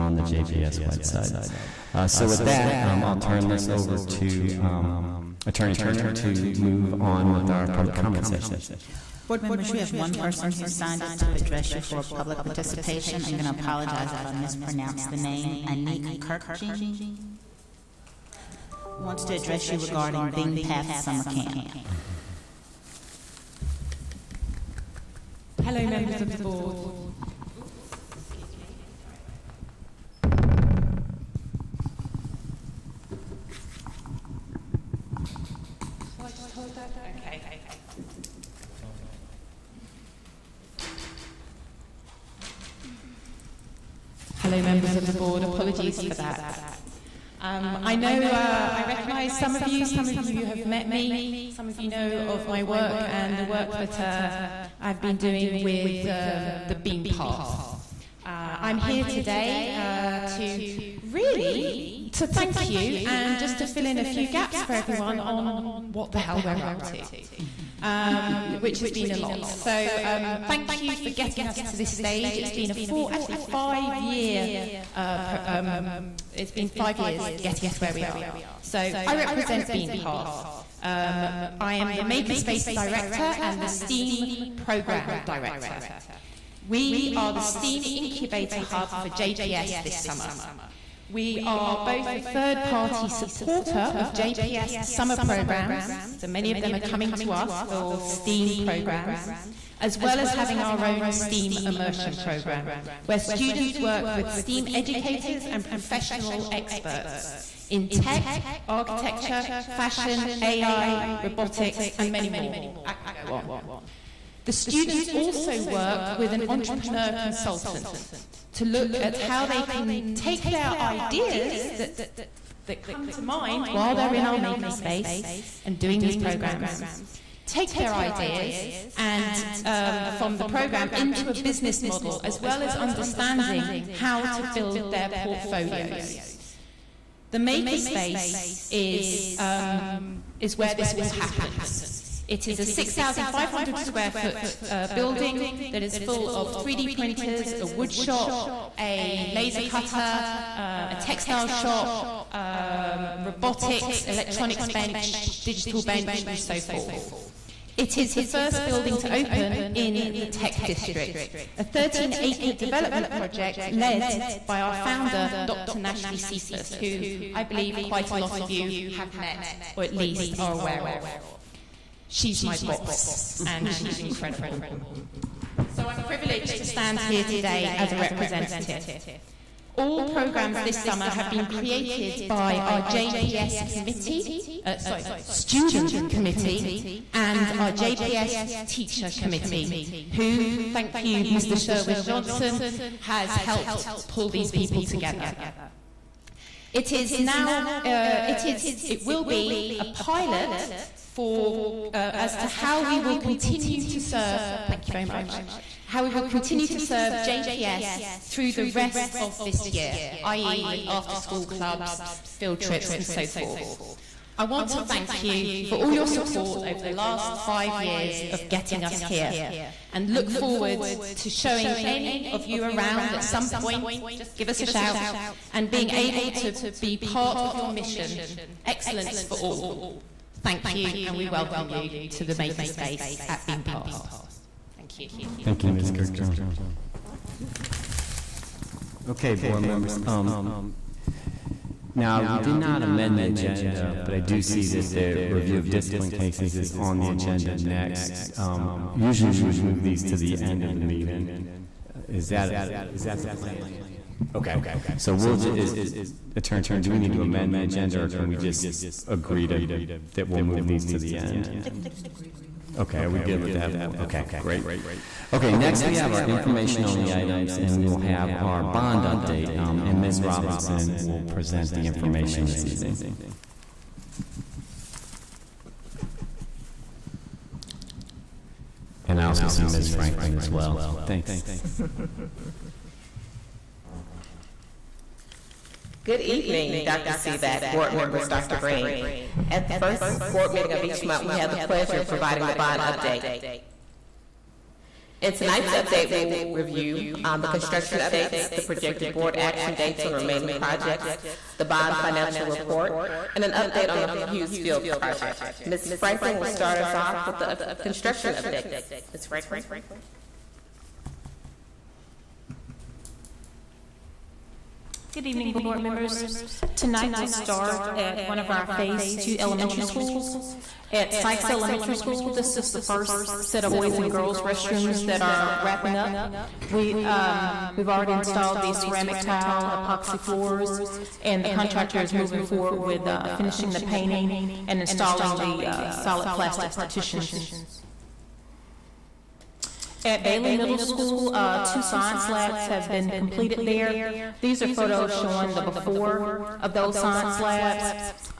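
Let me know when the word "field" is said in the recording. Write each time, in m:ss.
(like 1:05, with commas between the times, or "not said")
3:32, 5:04.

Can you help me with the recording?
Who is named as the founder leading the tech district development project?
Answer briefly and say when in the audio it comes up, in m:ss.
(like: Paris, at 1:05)
Dr. Nashlie Sephus, at 2:45.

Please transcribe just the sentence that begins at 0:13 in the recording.
I'm going to apologize if I mispronounce the name.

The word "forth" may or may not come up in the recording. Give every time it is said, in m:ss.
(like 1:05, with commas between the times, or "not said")
2:36, 3:33.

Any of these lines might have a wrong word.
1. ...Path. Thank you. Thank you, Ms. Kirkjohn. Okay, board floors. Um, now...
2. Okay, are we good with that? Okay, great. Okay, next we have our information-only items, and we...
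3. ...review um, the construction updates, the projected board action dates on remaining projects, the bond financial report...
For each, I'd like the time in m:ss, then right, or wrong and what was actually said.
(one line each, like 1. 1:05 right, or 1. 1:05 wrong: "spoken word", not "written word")
1. 3:53 wrong: "members", not "floors"
2. 4:22 right
3. 4:56 right.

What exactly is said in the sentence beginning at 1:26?
We are the STEAM Incubator Hub for JPS this summer.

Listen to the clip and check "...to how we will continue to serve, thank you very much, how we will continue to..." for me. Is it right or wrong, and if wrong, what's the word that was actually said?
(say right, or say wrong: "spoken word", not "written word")
right.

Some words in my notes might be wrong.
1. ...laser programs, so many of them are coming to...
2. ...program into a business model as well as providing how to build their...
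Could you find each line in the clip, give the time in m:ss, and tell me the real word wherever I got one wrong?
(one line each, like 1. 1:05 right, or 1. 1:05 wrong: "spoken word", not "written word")
1. 1:34 wrong: "summer", not "laser"
2. 2:10 wrong: "understanding", not "providing".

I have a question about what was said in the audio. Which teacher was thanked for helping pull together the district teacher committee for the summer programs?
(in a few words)
Sherwin Johnson.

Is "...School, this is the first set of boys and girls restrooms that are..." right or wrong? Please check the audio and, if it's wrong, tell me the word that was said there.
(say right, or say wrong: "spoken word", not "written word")
right.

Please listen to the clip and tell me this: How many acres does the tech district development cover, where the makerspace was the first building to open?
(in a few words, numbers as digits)
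13.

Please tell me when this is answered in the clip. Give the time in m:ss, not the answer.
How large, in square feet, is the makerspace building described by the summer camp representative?
2:22.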